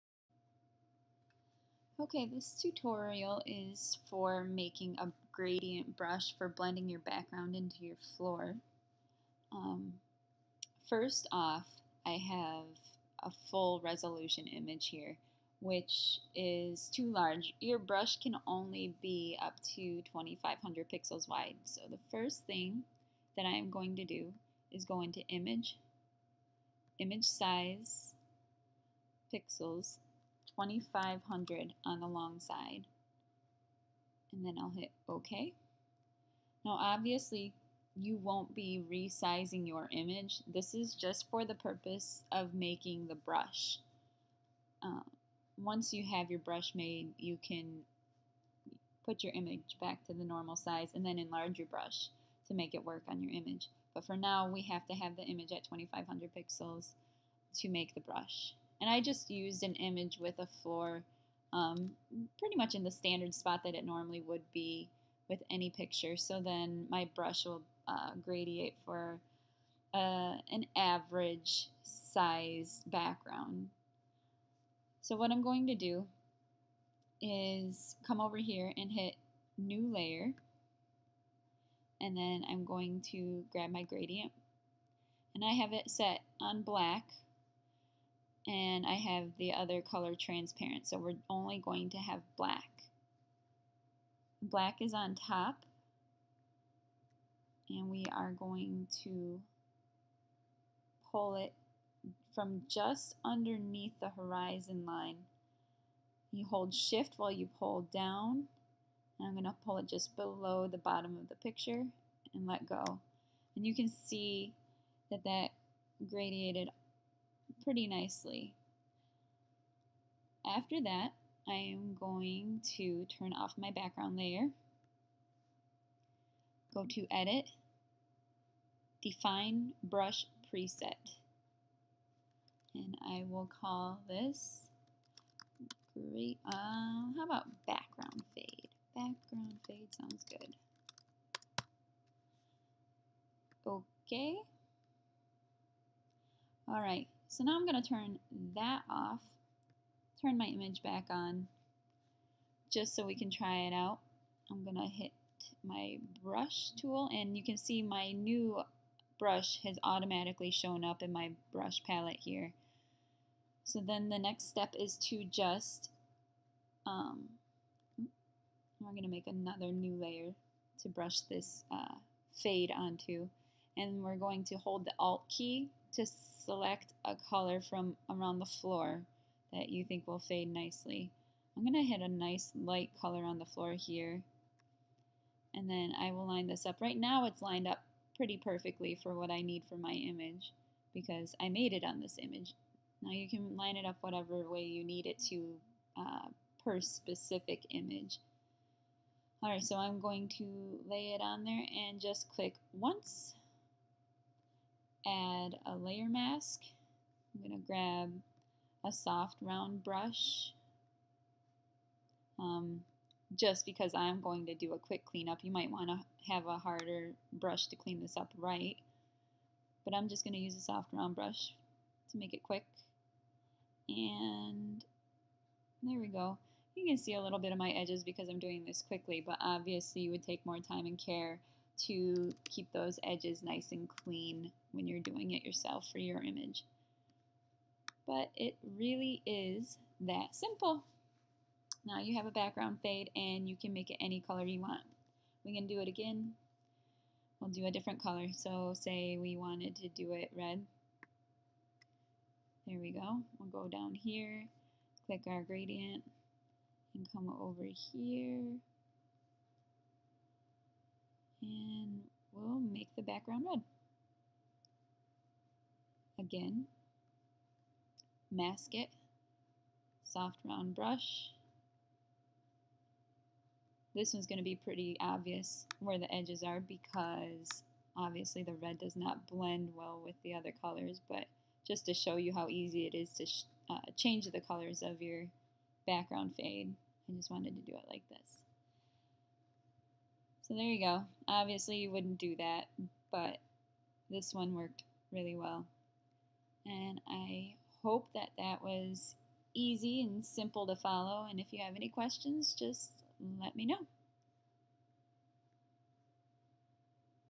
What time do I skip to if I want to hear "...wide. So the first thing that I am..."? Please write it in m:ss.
0:21.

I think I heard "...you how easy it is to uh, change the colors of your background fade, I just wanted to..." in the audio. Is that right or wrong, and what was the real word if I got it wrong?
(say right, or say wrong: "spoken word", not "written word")
right.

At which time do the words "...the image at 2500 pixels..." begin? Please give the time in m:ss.
0:55.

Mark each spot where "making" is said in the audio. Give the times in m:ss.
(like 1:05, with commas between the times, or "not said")
0:04, 0:42.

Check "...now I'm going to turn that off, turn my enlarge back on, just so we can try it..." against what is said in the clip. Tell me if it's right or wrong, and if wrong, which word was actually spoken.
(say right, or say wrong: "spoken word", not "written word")
wrong: "image", not "enlarge".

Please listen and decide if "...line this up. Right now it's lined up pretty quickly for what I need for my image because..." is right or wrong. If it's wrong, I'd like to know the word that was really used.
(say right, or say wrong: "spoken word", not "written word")
wrong: "perfectly", not "quickly".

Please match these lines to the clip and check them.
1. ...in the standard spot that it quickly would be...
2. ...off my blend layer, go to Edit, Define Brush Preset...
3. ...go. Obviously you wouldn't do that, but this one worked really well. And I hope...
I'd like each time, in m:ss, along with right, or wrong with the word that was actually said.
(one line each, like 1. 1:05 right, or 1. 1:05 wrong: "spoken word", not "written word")
1. 1:02 wrong: "normally", not "quickly"
2. 2:03 wrong: "background", not "blend"
3. 4:50 right.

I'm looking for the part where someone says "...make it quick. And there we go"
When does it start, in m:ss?
3:42.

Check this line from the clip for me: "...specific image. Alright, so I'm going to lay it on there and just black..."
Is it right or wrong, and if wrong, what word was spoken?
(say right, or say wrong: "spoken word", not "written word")
wrong: "click", not "black".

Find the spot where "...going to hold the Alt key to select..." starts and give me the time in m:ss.
2:54.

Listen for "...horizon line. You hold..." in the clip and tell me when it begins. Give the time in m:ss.
1:44.